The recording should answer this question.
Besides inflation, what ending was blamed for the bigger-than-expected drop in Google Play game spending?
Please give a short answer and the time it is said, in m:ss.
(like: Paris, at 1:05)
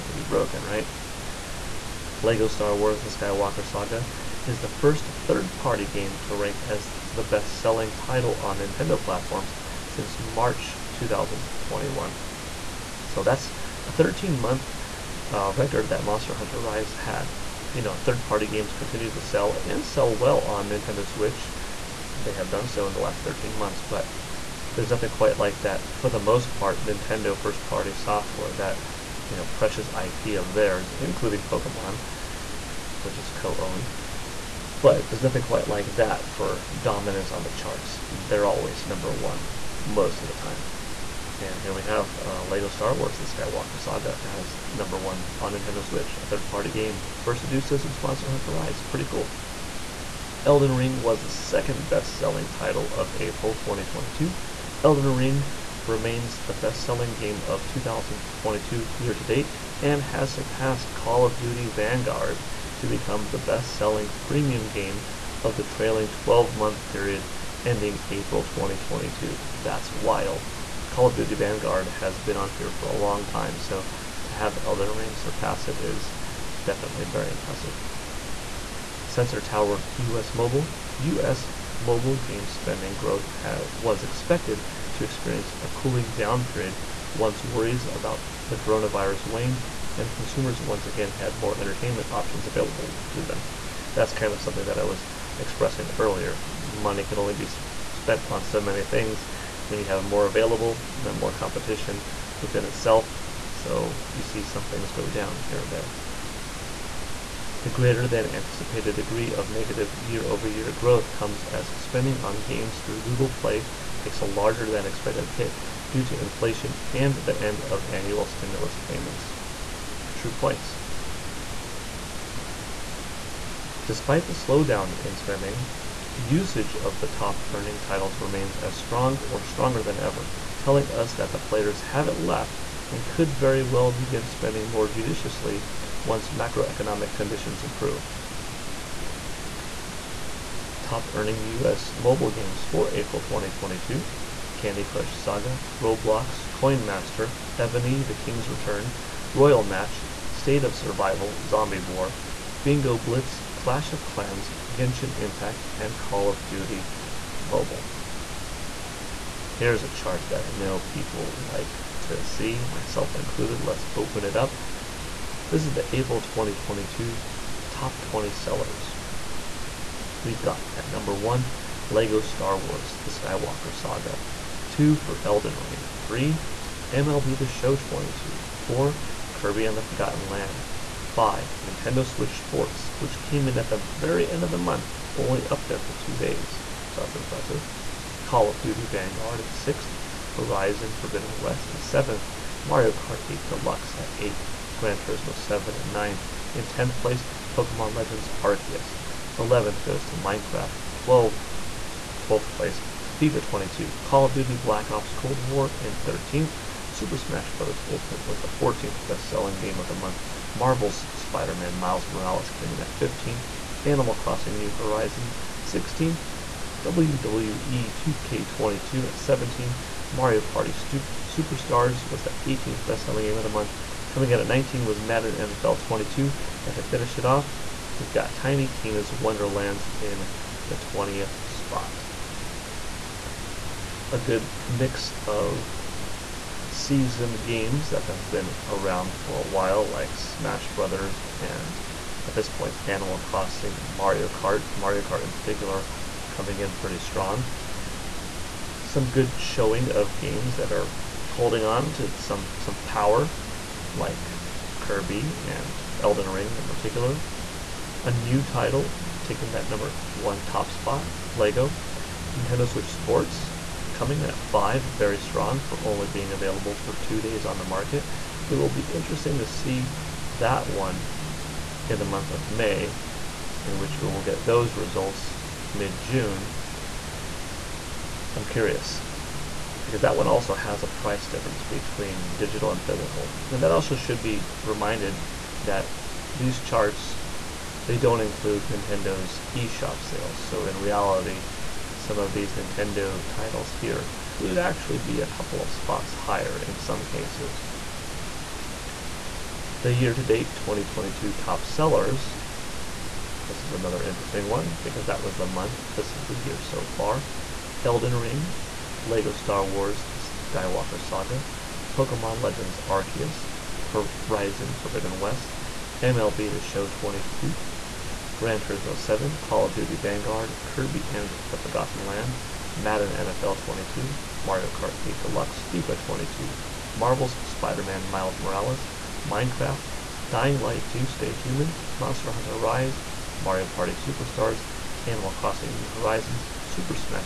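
annual stimulus payments, at 1:57.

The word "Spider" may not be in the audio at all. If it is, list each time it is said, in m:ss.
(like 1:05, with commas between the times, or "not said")
3:31, 5:27.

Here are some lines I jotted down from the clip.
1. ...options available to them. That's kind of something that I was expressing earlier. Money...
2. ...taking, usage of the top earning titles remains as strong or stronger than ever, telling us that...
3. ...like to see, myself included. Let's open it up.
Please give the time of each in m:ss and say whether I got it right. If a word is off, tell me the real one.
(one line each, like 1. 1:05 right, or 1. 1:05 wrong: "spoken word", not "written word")
1. 1:32 right
2. 2:05 wrong: "spending", not "taking"
3. 2:41 right.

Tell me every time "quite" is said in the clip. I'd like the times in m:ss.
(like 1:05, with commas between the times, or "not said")
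0:25, 0:35.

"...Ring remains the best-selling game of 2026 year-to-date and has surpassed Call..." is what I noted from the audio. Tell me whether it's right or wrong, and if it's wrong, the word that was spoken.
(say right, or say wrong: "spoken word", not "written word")
wrong: "2022", not "2026".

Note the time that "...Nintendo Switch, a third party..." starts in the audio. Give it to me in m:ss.
0:45.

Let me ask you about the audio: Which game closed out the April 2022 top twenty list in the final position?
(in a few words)
Tiny Tina's Wonderlands.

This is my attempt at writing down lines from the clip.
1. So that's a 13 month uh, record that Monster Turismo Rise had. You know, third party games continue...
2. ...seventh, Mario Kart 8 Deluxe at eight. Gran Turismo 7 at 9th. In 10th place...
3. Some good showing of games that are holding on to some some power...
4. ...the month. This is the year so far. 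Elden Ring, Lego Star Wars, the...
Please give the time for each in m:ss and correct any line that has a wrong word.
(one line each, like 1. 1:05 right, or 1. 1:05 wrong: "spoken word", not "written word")
1. 0:13 wrong: "Hunter", not "Turismo"
2. 3:11 right
3. 4:08 right
4. 5:05 right.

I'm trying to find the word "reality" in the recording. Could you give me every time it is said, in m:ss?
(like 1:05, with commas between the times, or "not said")
4:50.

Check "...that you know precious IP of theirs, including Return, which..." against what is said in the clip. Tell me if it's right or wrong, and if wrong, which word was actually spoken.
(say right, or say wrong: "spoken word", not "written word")
wrong: "Pokemon", not "Return".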